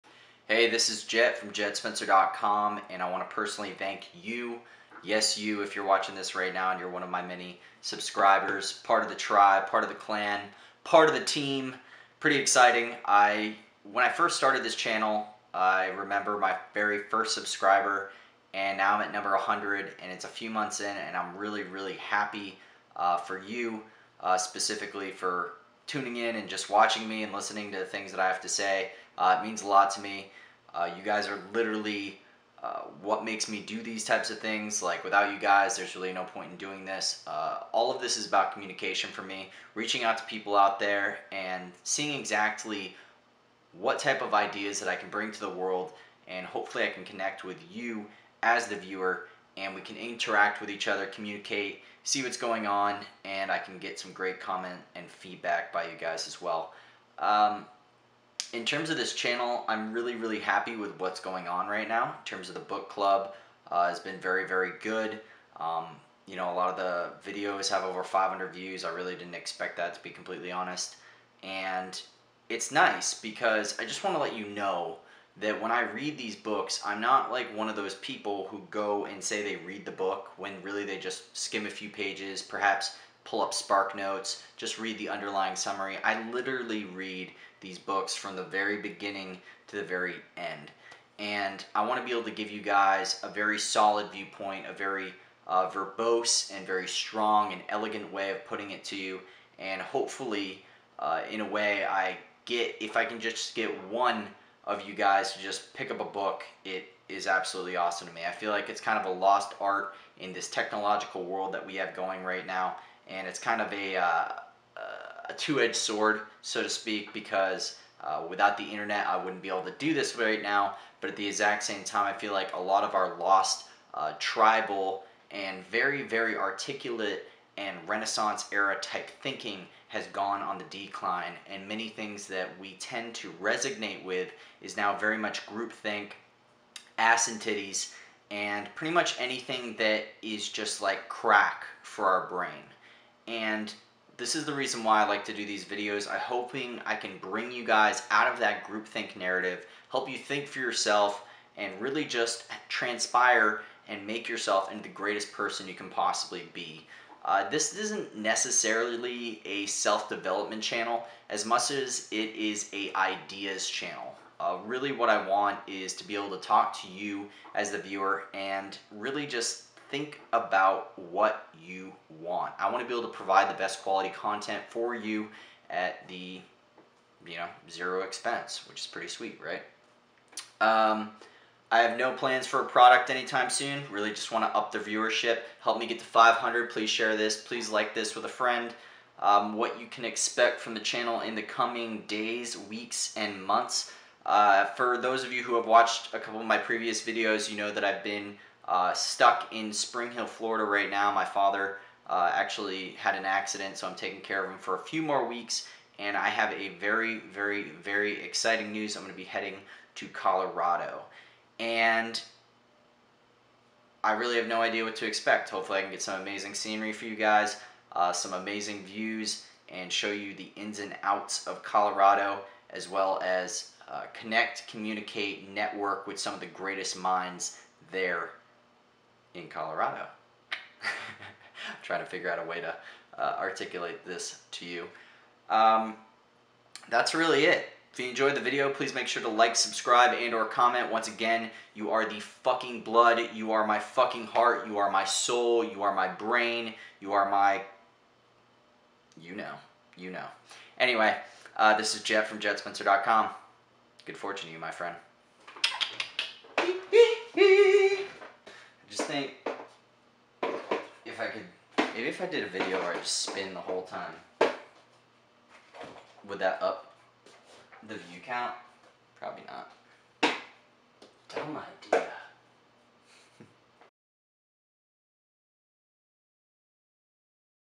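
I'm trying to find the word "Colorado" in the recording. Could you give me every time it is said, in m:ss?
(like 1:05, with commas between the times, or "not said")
3:30, 3:41, 3:49.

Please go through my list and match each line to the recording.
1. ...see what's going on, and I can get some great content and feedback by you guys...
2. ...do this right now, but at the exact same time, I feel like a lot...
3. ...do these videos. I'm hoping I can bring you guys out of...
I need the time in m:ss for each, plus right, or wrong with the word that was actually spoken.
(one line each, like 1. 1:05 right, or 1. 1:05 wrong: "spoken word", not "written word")
1. 0:52 wrong: "comment", not "content"
2. 1:59 right
3. 2:25 right.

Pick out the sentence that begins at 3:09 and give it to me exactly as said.
Um, what you can expect from the channel in the coming days, weeks, and months.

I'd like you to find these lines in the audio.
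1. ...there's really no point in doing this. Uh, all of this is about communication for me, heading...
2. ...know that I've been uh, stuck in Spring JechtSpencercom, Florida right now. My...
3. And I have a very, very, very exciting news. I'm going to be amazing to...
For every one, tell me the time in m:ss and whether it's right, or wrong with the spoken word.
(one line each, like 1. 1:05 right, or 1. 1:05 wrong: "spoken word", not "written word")
1. 0:35 wrong: "reaching", not "heading"
2. 3:17 wrong: "Hill", not "JechtSpencercom"
3. 3:25 wrong: "heading", not "amazing".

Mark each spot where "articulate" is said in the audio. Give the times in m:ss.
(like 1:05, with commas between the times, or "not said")
2:06, 3:53.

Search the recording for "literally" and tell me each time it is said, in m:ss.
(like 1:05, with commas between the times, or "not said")
0:31, 1:26.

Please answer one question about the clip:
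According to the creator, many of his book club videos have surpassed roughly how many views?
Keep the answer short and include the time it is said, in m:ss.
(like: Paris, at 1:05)
500, at 1:07.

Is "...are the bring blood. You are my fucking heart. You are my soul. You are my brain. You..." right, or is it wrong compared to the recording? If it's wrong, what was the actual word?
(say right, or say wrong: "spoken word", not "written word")
wrong: "fucking", not "bring".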